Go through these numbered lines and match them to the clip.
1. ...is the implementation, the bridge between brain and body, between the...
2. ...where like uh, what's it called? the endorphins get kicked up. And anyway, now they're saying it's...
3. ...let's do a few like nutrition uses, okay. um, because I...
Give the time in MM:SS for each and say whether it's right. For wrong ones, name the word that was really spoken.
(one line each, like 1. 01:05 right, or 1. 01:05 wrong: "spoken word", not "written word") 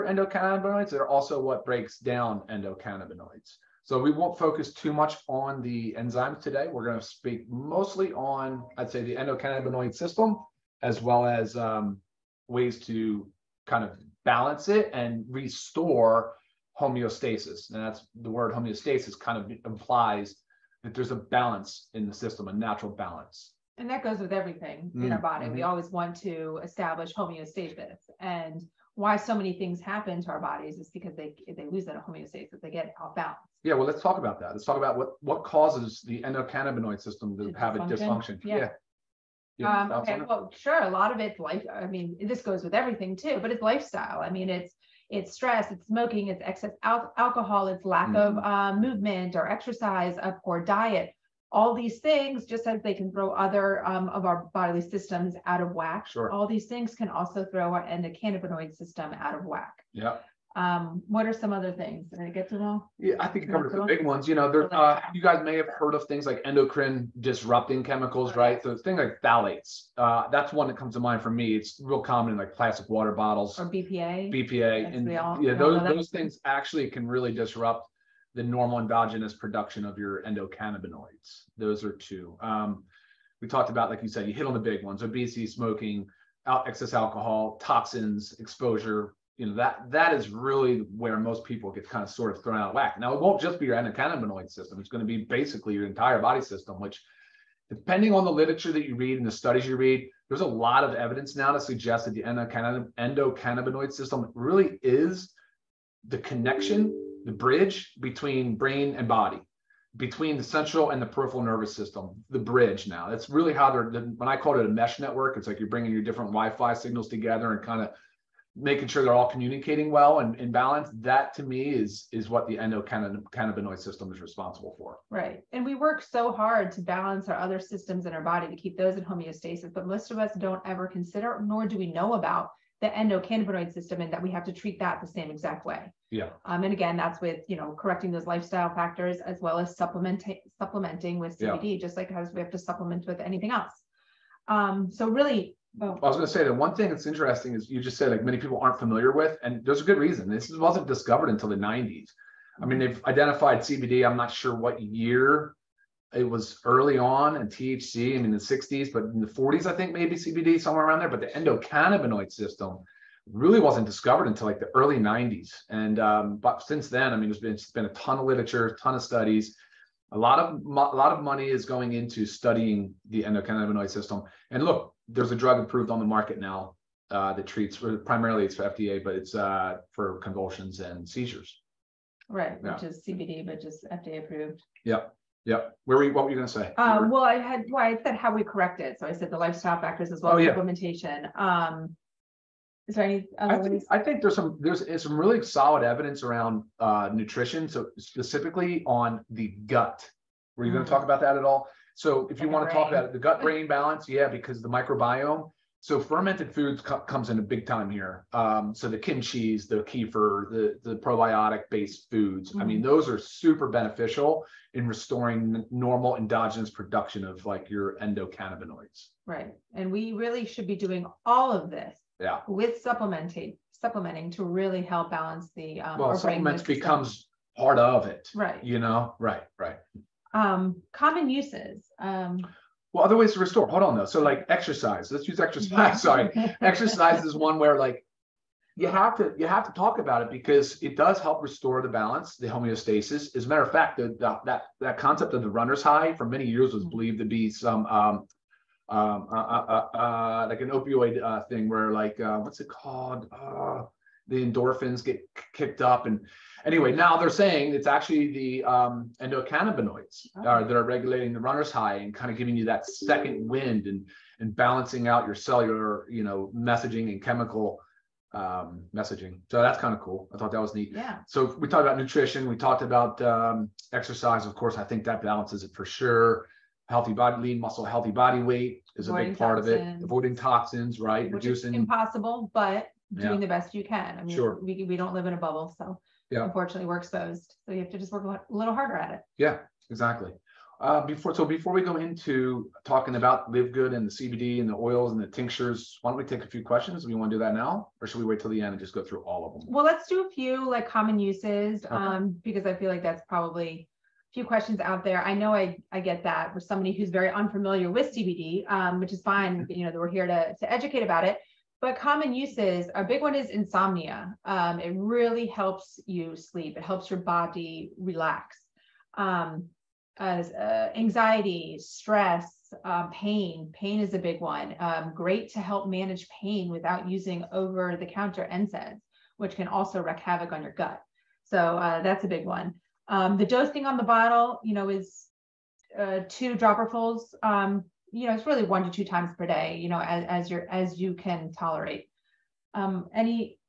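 1. 01:44 wrong: "connection", not "implementation"
2. 04:11 right
3. 04:59 wrong: "common", not "nutrition".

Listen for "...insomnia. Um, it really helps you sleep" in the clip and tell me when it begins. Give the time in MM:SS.
05:13.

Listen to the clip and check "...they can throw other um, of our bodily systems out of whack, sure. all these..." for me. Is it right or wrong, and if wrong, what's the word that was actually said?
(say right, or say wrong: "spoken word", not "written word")
right.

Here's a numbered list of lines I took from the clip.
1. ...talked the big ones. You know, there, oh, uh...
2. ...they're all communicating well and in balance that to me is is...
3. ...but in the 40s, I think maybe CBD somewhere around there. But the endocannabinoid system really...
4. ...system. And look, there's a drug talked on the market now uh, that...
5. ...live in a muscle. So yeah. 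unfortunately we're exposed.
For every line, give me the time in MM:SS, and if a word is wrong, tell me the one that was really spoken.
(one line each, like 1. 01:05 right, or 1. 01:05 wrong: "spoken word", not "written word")
1. 01:03 wrong: "covered", not "talked"
2. 01:59 right
3. 02:38 right
4. 02:53 wrong: "approved", not "talked"
5. 04:45 wrong: "bubble", not "muscle".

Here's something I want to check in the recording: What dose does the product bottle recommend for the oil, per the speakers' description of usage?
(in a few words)
2 dropperfuls.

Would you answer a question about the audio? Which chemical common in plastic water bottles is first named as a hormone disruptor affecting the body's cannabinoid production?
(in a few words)
phthalates.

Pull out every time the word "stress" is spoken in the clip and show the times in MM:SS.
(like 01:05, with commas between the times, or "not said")
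00:45, 05:21.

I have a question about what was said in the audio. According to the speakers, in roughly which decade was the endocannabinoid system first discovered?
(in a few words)
the 90s.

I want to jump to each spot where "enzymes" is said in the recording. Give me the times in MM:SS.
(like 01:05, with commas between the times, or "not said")
00:05.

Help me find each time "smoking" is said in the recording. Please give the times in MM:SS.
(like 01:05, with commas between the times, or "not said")
00:45, 01:25.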